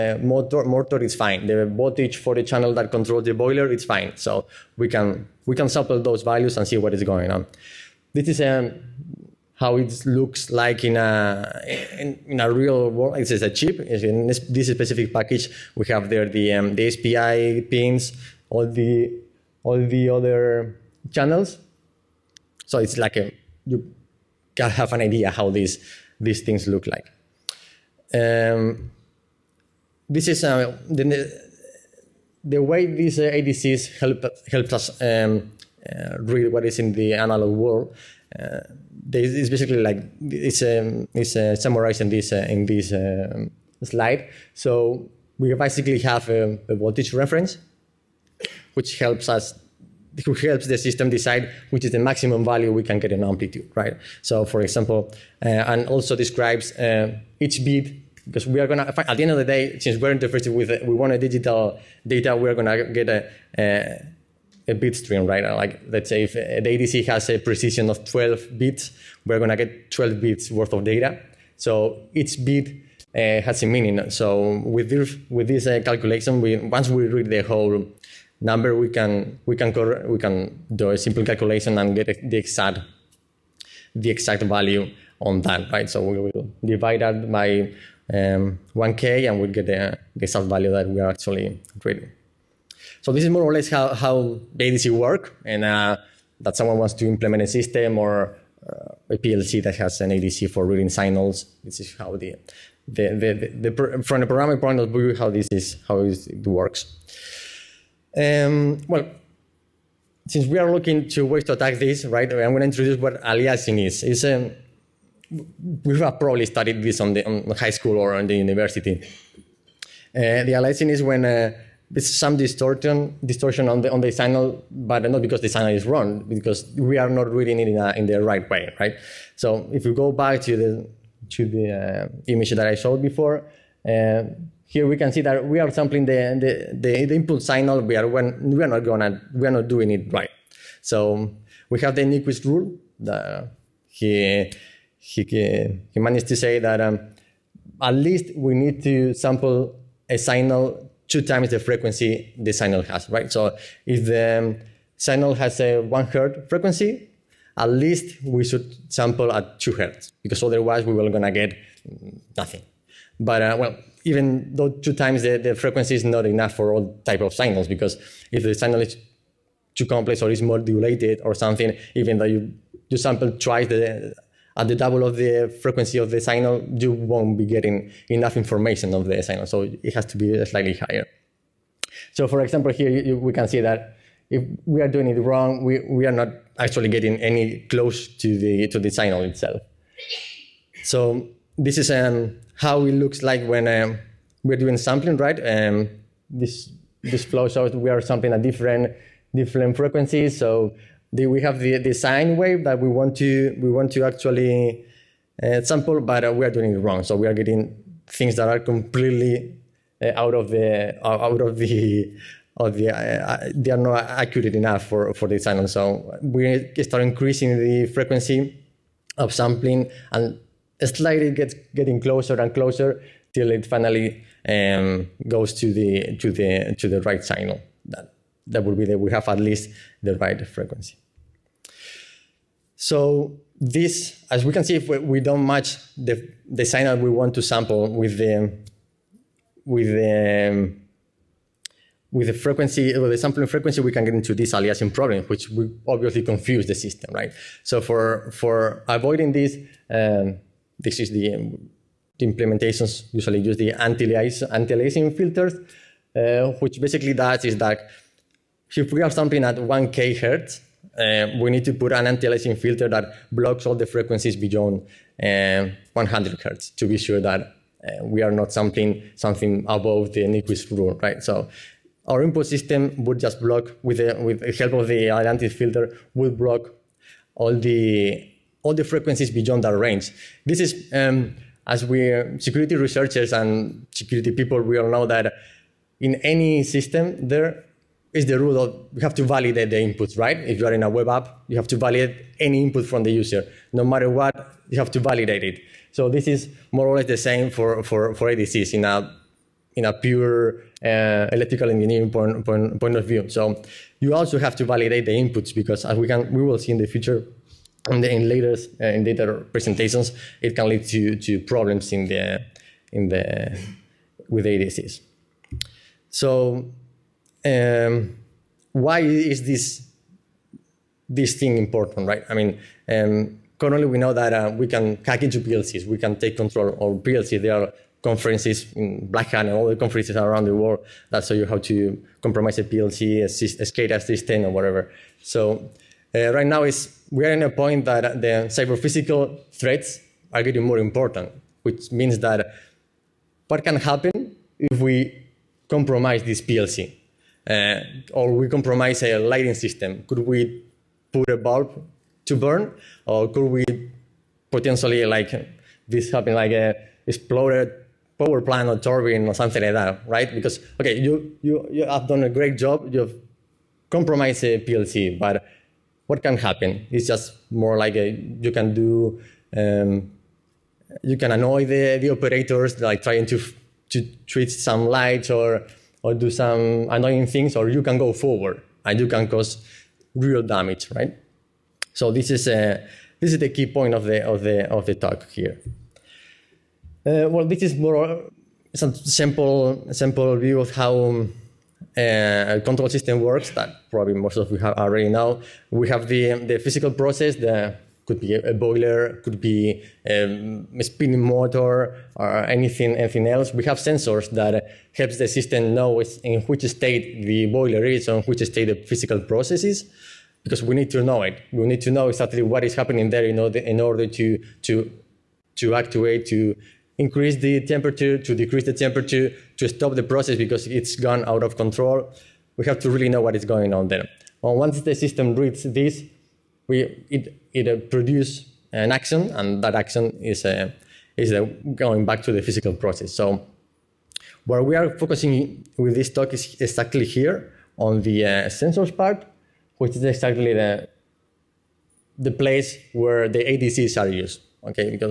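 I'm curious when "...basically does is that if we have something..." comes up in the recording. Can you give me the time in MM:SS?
04:16.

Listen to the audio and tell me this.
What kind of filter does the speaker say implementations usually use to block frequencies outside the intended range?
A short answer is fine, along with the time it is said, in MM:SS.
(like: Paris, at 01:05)
Anti-aliasing filters, at 04:13.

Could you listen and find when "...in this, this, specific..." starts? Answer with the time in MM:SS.
00:13.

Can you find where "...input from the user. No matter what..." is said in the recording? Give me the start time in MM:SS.
04:52.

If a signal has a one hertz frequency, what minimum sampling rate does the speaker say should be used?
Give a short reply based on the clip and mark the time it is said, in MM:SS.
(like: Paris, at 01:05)
2 hertz, at 02:39.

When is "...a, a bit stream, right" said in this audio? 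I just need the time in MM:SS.
01:03.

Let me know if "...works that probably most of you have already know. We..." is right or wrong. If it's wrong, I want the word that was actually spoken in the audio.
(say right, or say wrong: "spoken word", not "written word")
right.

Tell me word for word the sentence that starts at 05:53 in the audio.
Or could we potentially, like this happen, like a exploded power plant or turbine or something like that, right?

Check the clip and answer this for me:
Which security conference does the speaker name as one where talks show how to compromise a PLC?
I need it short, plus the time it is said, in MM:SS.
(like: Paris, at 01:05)
Black Hat, at 05:29.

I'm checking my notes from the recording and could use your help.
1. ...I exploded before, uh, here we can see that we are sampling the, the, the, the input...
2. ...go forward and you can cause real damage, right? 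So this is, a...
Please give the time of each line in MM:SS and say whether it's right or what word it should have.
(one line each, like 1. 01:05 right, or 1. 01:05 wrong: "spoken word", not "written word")
1. 02:12 wrong: "showed", not "exploded"
2. 06:17 right.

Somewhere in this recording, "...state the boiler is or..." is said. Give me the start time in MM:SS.
06:46.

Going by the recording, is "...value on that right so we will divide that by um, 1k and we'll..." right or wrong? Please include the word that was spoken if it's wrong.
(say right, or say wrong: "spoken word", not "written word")
right.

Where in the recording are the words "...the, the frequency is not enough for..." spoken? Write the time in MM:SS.
02:45.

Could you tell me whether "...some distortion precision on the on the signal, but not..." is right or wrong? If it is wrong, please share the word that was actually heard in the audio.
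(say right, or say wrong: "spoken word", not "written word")
wrong: "distortion", not "precision".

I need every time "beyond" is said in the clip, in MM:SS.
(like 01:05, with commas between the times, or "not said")
04:24, 04:39.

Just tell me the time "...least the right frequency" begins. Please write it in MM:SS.
03:49.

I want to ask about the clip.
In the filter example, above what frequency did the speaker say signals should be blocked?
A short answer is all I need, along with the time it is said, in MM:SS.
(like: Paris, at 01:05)
100 hertz, at 04:25.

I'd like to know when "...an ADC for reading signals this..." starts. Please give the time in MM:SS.
01:39.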